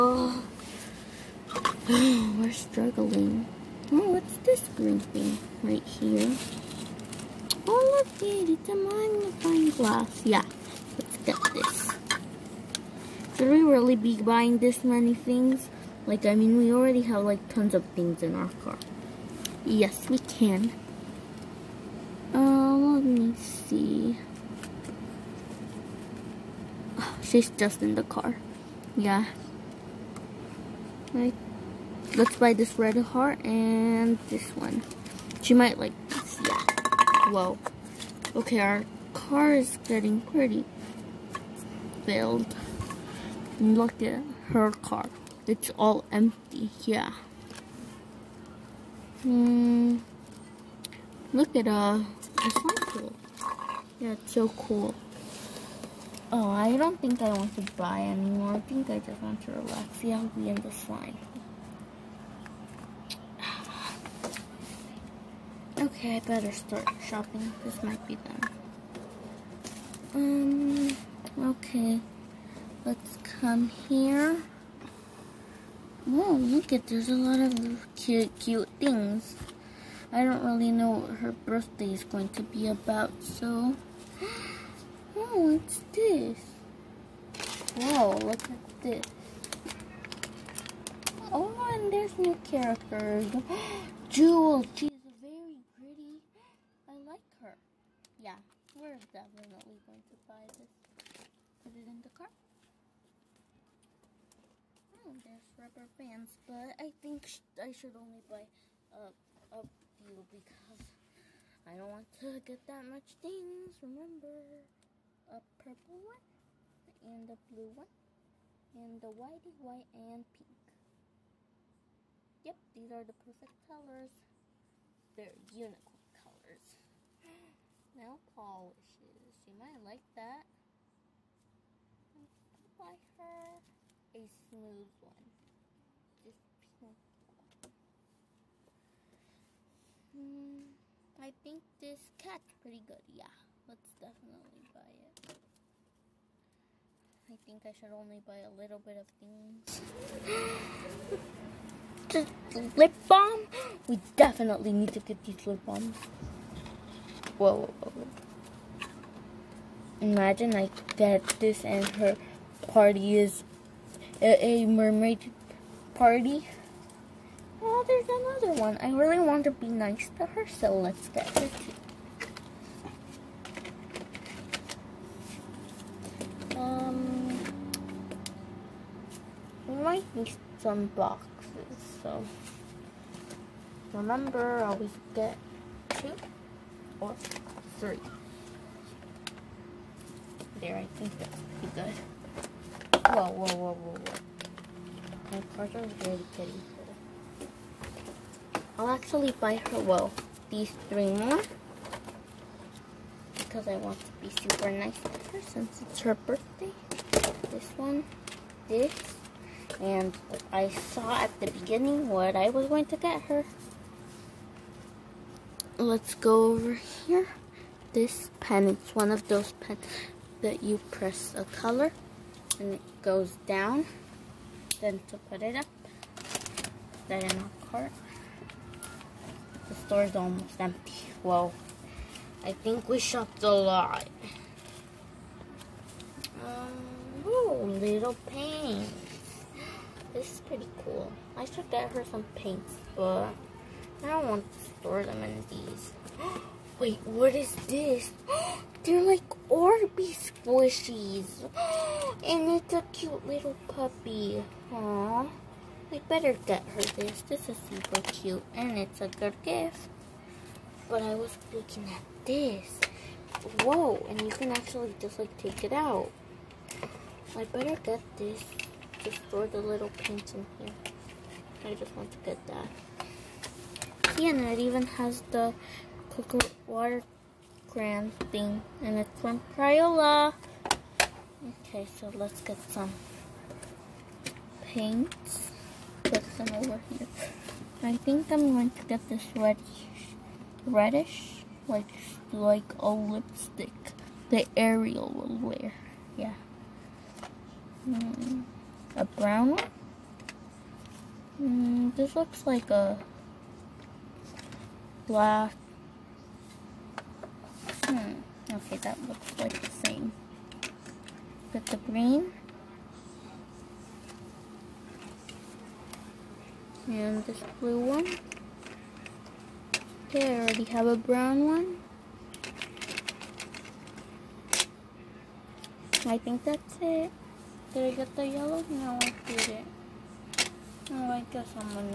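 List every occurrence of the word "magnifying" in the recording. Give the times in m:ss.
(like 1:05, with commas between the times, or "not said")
0:08.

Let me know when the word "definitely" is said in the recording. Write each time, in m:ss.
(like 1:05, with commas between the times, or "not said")
1:38, 2:23, 2:34.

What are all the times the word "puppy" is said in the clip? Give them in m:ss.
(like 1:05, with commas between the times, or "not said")
4:13.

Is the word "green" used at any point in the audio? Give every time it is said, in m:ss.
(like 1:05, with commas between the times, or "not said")
0:04, 5:11.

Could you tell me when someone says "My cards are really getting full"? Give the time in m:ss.
3:15.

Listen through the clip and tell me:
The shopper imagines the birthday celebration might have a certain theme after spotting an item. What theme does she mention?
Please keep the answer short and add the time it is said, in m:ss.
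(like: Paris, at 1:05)
mermaid, at 2:44.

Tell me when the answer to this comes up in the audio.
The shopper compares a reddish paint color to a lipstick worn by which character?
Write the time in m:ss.
4:54.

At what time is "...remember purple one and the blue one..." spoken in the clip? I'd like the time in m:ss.
1:53.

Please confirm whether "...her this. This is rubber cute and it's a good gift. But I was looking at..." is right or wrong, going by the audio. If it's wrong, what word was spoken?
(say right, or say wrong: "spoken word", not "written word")
wrong: "super", not "rubber".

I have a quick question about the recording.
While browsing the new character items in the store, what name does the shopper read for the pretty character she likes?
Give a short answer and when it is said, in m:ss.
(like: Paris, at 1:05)
Jewel, at 1:34.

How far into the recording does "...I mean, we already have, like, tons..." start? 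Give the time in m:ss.
0:16.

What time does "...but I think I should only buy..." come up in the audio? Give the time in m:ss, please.
1:46.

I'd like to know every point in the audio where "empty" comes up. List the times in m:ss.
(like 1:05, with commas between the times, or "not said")
0:46, 3:50.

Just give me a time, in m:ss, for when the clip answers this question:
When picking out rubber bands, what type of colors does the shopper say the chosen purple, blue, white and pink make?
2:05.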